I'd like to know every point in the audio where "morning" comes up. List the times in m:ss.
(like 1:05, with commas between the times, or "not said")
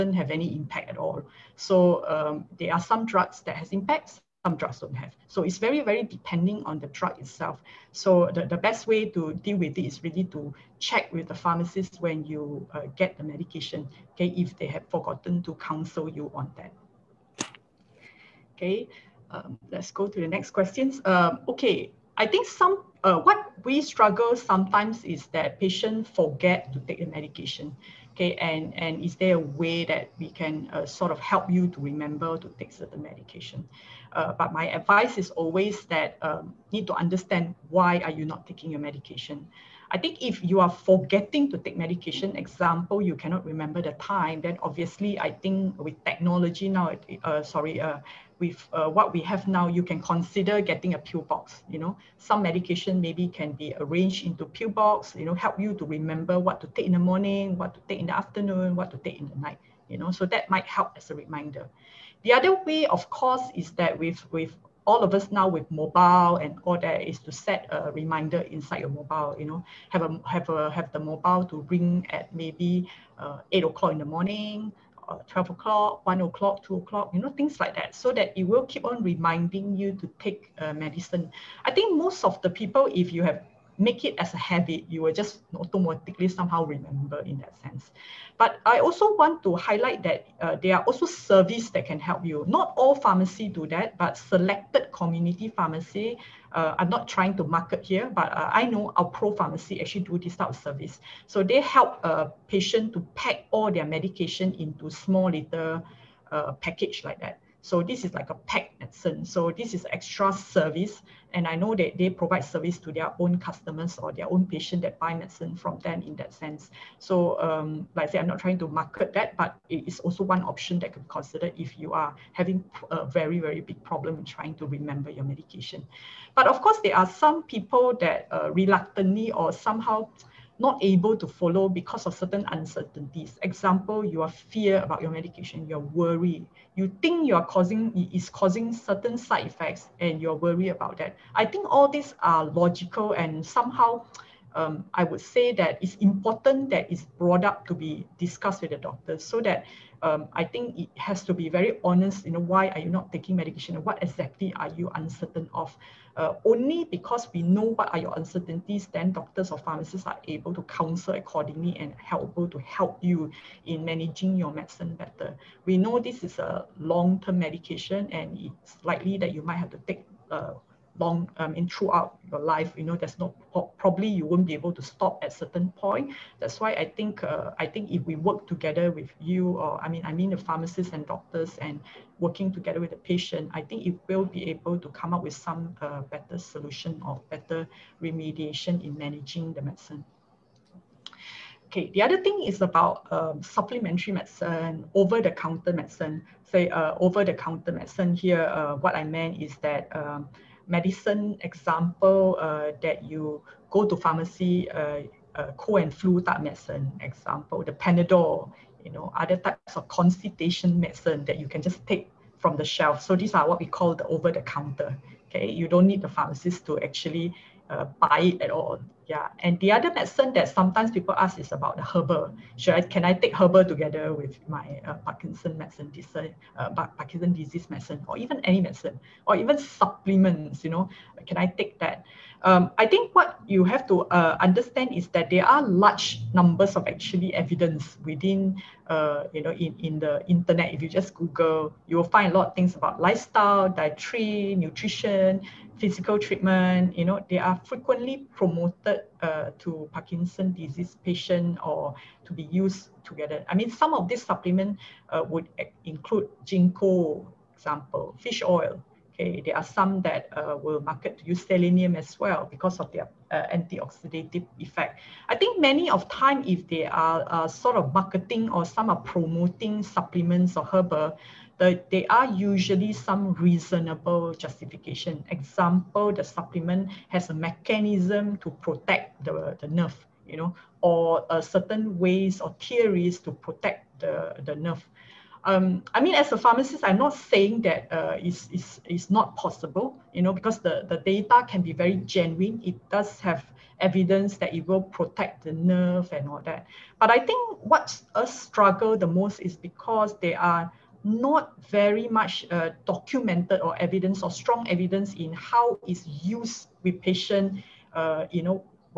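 0:56, 1:14.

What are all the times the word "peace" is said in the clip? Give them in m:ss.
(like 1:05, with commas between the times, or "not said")
not said.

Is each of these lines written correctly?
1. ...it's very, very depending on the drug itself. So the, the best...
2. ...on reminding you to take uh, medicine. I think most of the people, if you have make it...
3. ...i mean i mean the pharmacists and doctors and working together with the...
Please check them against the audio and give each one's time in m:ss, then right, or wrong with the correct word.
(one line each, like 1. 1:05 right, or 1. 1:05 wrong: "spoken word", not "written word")
1. 0:05 right
2. 1:18 right
3. 2:59 right.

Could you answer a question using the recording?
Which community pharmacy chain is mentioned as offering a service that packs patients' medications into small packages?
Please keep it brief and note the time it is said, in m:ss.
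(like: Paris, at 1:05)
Alpro pharmacy, at 1:38.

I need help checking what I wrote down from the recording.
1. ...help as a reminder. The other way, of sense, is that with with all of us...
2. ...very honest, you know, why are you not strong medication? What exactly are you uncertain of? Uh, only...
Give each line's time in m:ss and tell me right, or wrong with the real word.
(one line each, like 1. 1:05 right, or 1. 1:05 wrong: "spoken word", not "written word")
1. 1:00 wrong: "course", not "sense"
2. 2:31 wrong: "taking", not "strong".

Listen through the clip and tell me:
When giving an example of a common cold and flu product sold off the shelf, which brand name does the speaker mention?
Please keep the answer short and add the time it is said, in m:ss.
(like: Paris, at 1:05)
Panadol, at 3:27.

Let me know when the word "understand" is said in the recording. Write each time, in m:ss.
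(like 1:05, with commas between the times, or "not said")
0:36, 3:54.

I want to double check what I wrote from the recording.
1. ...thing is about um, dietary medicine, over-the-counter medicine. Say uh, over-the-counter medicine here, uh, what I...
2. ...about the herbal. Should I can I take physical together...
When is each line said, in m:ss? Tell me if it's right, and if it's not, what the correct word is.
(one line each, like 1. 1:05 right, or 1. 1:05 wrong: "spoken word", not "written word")
1. 3:12 wrong: "supplementary", not "dietary"
2. 3:41 wrong: "herbal", not "physical".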